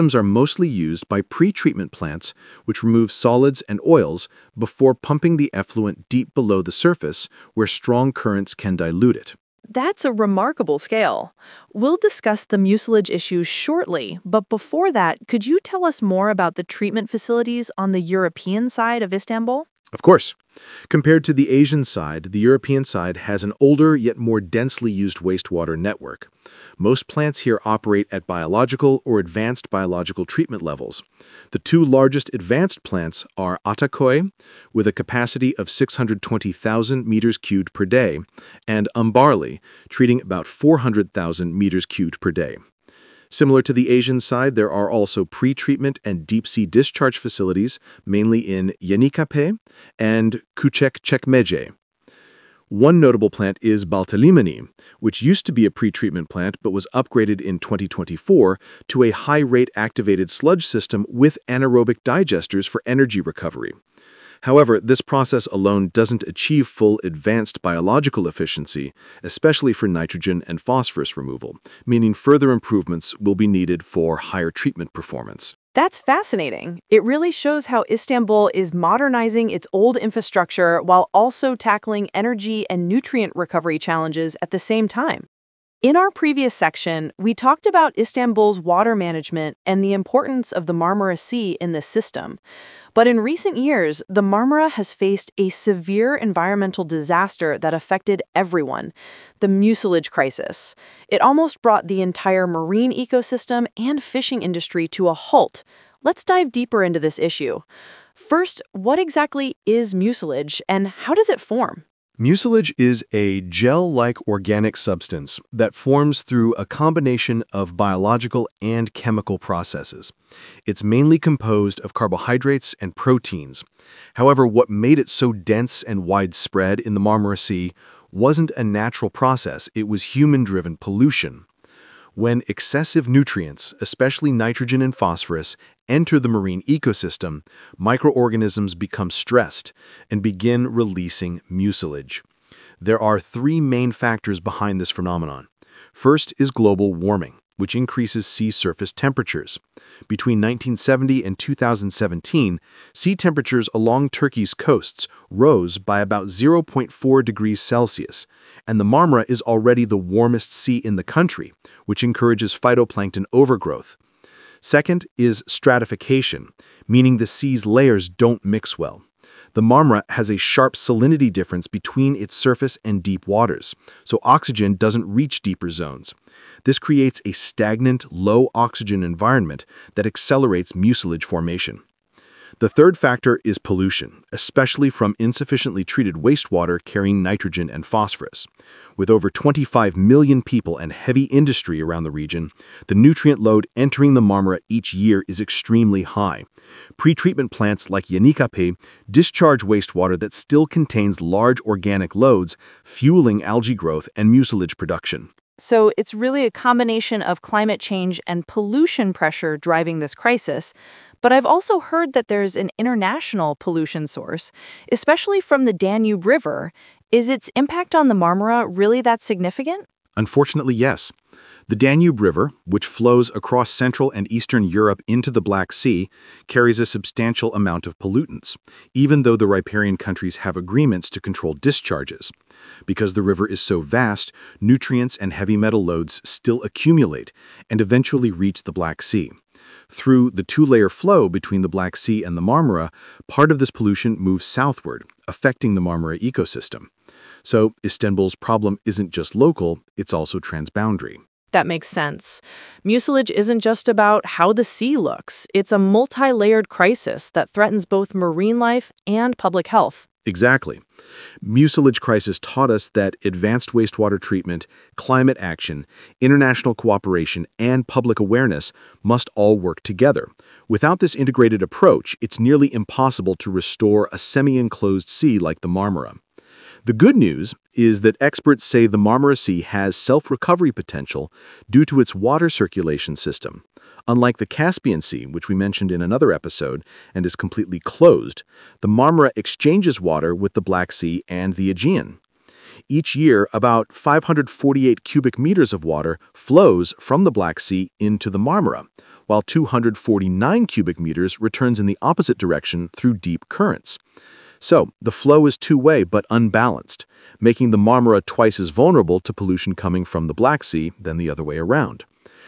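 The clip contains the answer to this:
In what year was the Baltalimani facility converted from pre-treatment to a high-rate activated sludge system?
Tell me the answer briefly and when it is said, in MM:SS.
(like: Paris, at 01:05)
2024, at 00:57.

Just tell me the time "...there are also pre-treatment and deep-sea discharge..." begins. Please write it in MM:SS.
00:44.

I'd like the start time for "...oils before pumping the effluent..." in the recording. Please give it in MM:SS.
00:03.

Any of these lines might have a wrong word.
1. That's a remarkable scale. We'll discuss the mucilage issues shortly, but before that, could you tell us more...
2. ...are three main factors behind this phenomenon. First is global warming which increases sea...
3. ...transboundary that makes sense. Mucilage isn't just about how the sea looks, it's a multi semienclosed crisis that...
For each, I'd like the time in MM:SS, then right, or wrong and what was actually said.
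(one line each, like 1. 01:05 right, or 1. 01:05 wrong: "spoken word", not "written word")
1. 00:09 right
2. 02:22 right
3. 04:10 wrong: "layered", not "semienclosed".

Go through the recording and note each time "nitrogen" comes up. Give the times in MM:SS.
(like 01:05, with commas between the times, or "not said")
01:09, 02:14, 03:07.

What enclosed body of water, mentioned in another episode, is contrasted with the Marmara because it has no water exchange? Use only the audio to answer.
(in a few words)
Caspian Sea.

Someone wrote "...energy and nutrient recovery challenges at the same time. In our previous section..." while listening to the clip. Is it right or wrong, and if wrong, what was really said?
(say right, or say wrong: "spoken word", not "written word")
right.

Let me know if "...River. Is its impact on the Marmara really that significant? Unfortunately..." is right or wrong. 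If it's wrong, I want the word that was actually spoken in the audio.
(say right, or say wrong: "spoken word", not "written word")
right.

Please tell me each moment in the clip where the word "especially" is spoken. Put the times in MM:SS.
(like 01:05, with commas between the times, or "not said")
01:09, 02:13, 03:04, 03:34.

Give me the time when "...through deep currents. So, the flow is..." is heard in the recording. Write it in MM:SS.
05:02.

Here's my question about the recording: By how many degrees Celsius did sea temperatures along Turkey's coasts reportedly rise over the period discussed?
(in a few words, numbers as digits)
0.4 degrees.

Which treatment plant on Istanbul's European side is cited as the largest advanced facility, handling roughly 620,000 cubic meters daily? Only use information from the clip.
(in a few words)
Ataköy.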